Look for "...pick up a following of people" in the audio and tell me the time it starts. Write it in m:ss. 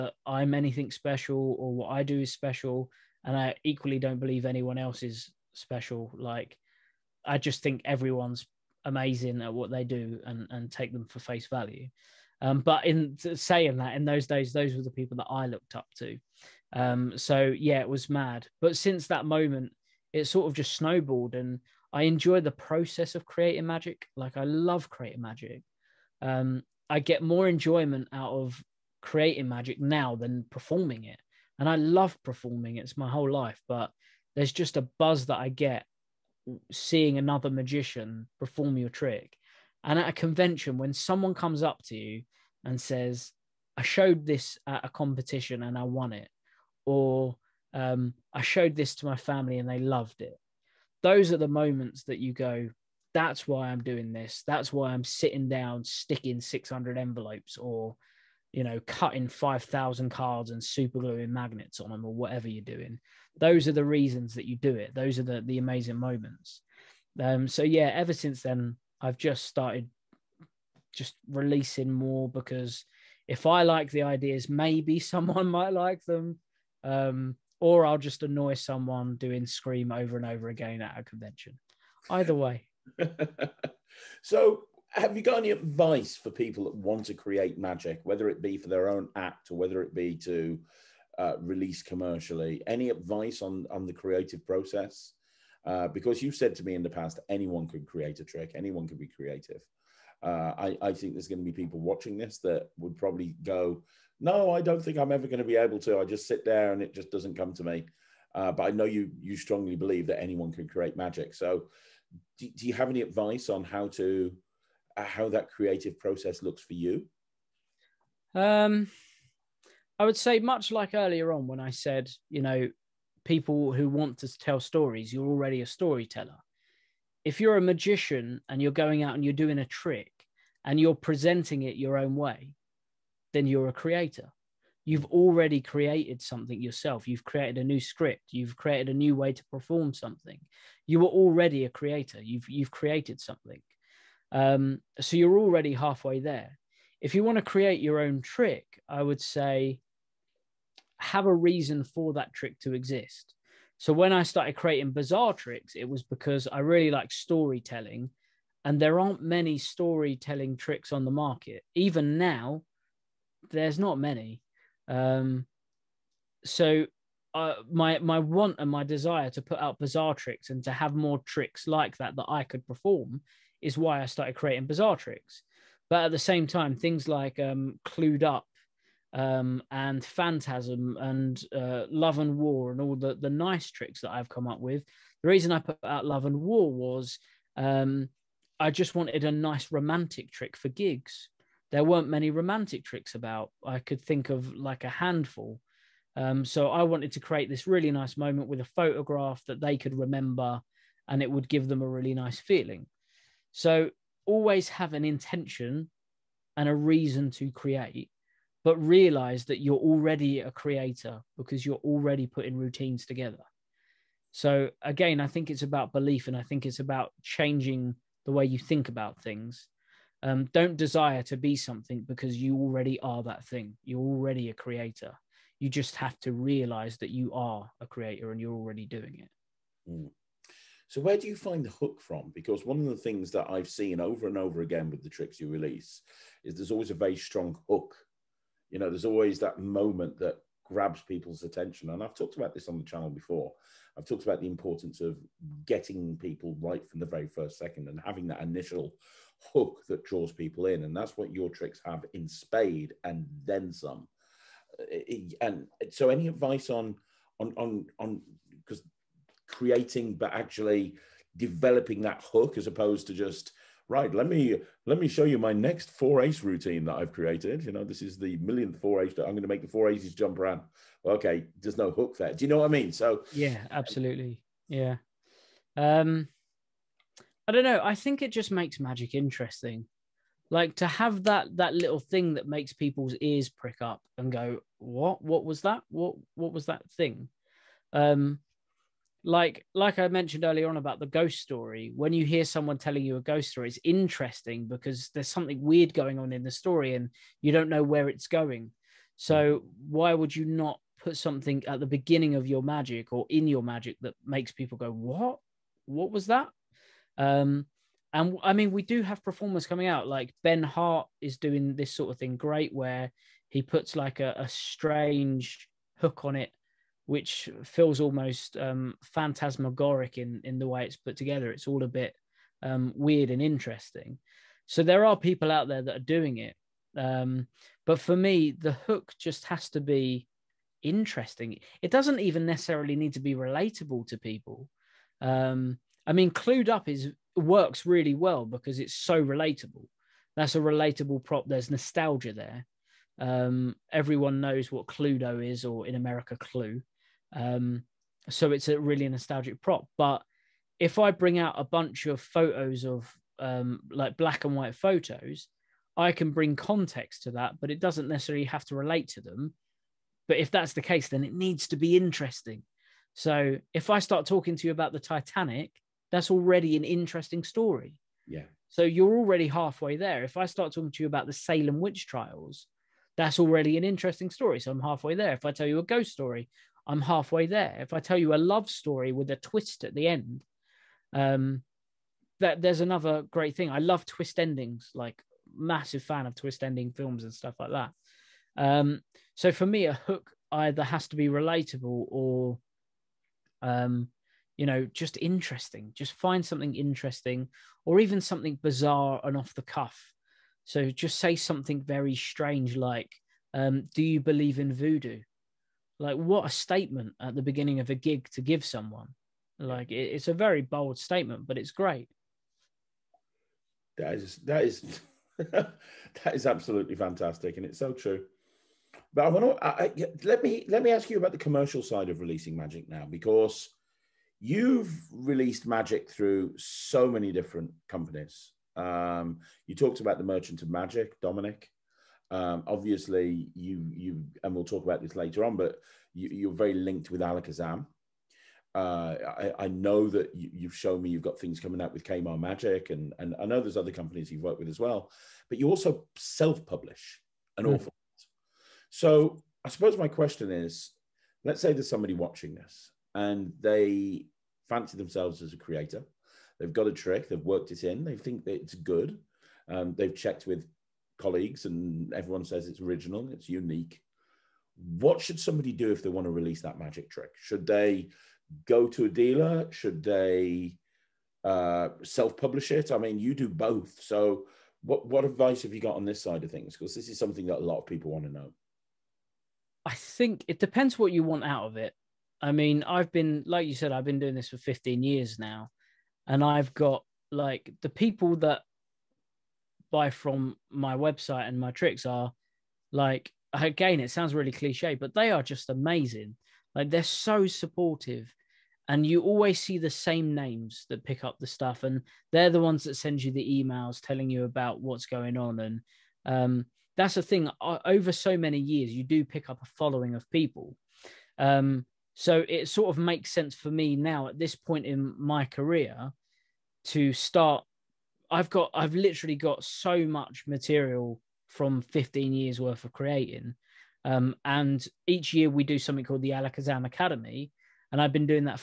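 8:29.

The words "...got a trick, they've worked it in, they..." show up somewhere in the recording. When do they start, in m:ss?
7:36.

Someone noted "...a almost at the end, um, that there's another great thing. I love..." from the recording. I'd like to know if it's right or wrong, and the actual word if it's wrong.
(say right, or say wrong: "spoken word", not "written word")
wrong: "twist", not "almost".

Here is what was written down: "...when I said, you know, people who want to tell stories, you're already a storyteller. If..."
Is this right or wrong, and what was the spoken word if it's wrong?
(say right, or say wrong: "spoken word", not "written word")
right.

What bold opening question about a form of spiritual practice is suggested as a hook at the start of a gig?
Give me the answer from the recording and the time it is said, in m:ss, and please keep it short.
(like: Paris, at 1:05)
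Do you believe in voodoo?, at 6:43.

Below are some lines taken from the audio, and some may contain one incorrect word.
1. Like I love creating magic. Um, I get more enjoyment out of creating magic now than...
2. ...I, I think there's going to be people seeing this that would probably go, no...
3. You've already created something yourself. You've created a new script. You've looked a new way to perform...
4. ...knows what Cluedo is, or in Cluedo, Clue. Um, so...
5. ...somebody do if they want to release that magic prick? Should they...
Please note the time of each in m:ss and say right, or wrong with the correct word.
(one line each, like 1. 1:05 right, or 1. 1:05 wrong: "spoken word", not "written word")
1. 0:24 right
2. 1:40 wrong: "watching", not "seeing"
3. 2:14 wrong: "created", not "looked"
4. 5:44 wrong: "America", not "Cluedo"
5. 7:45 wrong: "trick", not "prick".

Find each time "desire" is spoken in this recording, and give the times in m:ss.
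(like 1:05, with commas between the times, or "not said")
2:48, 3:40.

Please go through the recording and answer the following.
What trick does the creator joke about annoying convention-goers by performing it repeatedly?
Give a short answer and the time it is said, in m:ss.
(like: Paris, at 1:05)
Scream, at 1:19.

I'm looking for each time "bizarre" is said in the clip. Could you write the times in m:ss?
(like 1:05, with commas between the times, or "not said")
2:34, 2:49, 2:54, 6:38.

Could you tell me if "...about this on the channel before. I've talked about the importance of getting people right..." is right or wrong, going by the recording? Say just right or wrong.
right.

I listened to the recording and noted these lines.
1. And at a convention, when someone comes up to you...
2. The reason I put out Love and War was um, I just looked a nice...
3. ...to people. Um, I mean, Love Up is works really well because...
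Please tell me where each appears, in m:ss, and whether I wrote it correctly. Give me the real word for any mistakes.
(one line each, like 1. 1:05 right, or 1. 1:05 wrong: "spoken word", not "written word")
1. 0:39 right
2. 3:05 wrong: "wanted", not "looked"
3. 5:34 wrong: "Clued", not "Love".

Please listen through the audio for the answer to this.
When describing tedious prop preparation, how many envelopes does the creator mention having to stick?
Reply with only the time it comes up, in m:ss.
0:56.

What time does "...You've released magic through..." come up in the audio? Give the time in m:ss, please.
7:04.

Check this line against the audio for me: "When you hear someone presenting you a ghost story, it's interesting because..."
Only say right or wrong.
wrong.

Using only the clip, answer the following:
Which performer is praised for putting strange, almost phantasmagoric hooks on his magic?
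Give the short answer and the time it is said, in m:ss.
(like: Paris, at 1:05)
Ben Hart, at 5:10.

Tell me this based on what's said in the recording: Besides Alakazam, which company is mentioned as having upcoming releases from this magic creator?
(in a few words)
Kaymar Magic.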